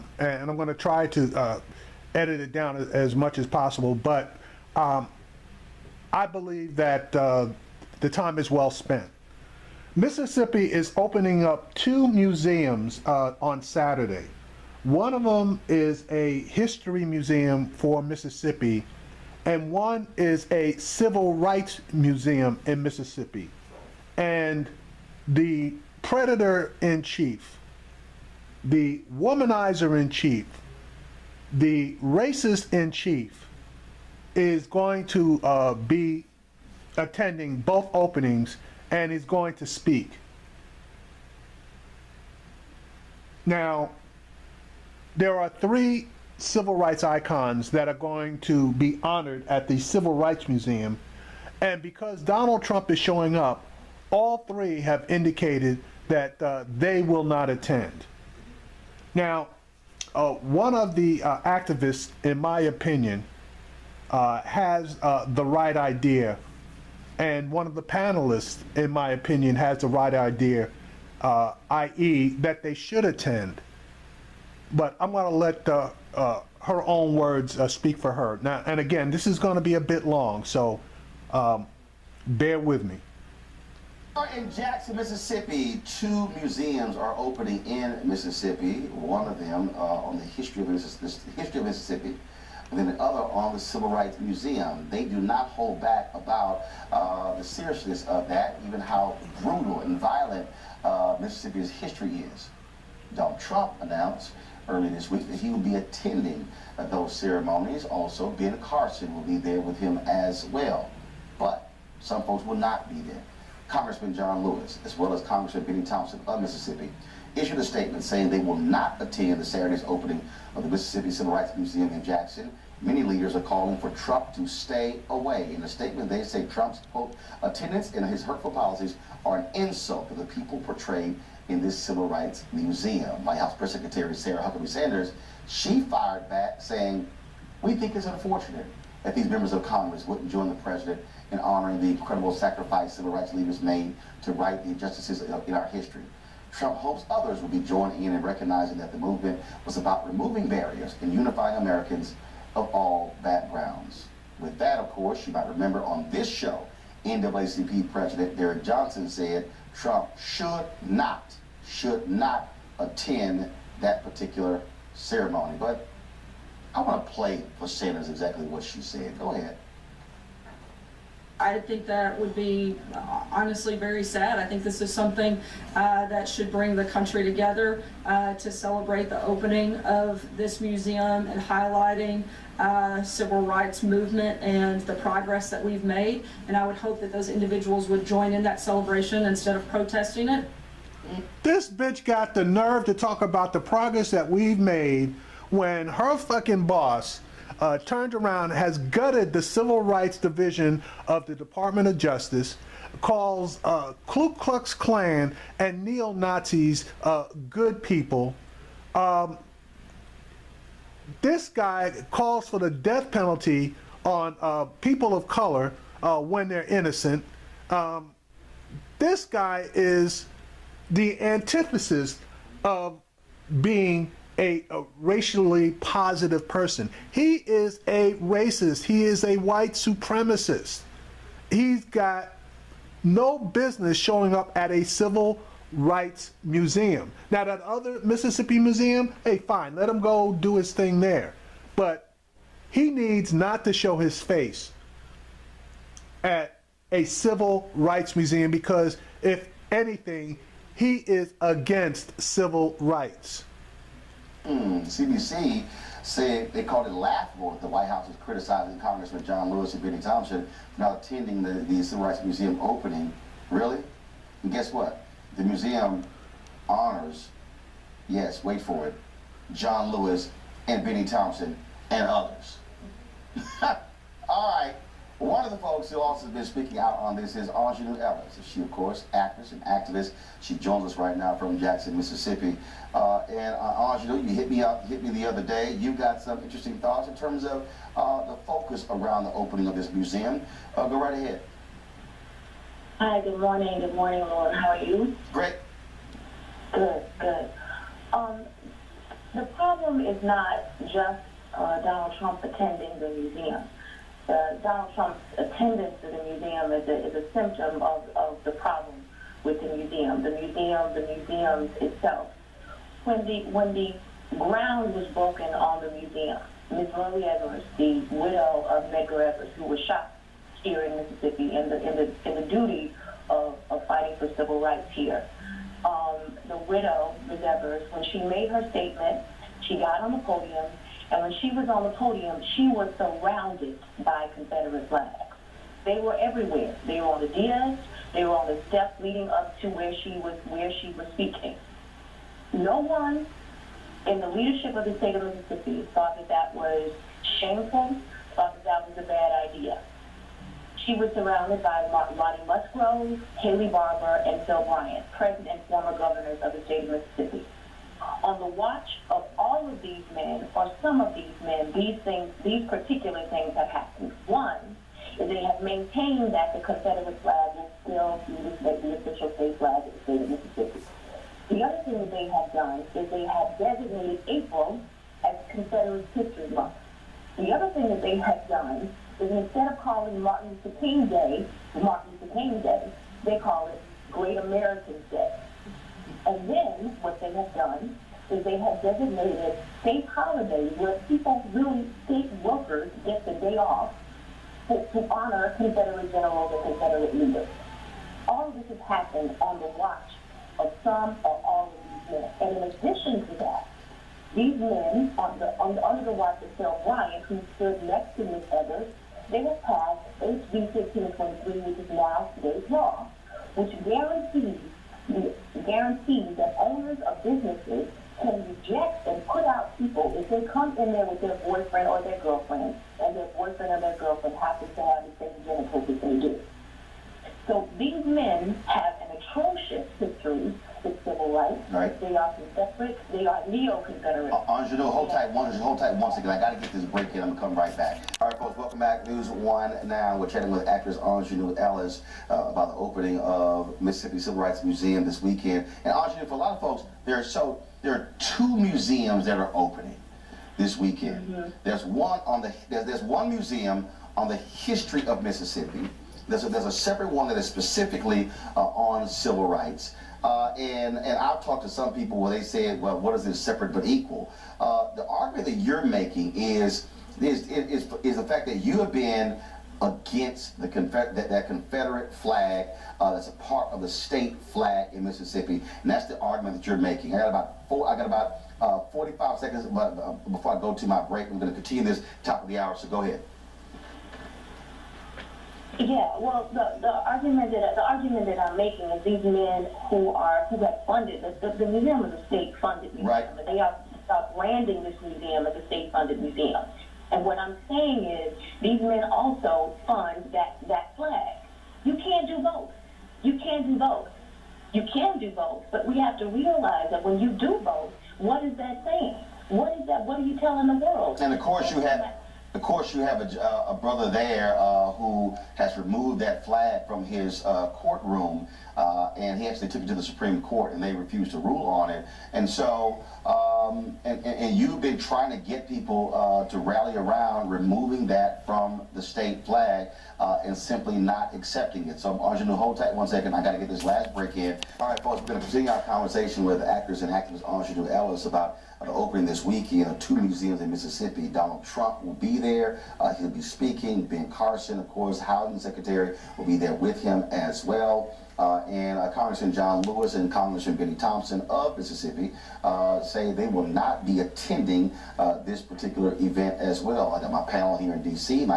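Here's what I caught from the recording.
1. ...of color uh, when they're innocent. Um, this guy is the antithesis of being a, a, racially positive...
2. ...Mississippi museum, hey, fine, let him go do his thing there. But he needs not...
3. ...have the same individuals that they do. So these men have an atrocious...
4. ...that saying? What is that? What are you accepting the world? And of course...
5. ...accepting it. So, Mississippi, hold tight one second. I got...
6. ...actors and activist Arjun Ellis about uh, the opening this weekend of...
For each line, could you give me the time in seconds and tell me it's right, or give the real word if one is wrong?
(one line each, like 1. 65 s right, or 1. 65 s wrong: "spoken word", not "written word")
1. 215 s right
2. 238 s right
3. 424 s wrong: "genitals", not "individuals"
4. 508 s wrong: "telling", not "accepting"
5. 531 s wrong: "Arjun", not "Mississippi"
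6. 536 s right.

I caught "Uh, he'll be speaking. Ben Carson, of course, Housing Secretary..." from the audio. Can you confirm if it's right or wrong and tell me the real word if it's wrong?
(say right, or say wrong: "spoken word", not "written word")
right.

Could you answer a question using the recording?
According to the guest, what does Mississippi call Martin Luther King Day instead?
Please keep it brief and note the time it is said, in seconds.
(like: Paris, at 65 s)
Great Americans Day, at 384 s.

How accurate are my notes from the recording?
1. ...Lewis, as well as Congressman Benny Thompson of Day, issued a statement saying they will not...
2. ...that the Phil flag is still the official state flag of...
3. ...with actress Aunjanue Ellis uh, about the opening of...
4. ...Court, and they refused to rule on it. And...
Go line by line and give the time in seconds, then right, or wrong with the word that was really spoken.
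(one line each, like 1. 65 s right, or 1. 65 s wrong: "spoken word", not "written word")
1. 114 s wrong: "Mississippi", not "Day"
2. 366 s wrong: "Confederate", not "Phil"
3. 440 s right
4. 520 s right.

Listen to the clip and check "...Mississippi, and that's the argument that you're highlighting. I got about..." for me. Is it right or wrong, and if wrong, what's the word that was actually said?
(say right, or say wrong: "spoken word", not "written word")
wrong: "making", not "highlighting".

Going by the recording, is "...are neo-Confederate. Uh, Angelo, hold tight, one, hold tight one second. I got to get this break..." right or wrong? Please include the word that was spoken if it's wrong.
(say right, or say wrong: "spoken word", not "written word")
right.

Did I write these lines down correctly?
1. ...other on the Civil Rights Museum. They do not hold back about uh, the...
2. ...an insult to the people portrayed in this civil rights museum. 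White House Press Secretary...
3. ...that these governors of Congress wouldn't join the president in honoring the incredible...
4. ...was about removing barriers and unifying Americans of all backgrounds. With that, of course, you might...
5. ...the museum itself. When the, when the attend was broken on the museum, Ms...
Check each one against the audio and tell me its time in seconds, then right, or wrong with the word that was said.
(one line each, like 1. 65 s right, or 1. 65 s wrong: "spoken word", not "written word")
1. 93 s right
2. 129 s right
3. 139 s wrong: "members", not "governors"
4. 149 s right
5. 310 s wrong: "ground", not "attend".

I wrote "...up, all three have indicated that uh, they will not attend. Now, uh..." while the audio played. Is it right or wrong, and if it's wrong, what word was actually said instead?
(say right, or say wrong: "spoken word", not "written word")
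right.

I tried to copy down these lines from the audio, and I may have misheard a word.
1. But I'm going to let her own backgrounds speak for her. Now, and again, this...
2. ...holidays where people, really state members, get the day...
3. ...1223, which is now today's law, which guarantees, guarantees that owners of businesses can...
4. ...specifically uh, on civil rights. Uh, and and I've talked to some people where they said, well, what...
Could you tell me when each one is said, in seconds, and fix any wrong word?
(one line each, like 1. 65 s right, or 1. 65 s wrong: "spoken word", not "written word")
1. 74 s wrong: "words", not "backgrounds"
2. 390 s wrong: "workers", not "members"
3. 410 s wrong: "1523", not "1223"
4. 457 s right.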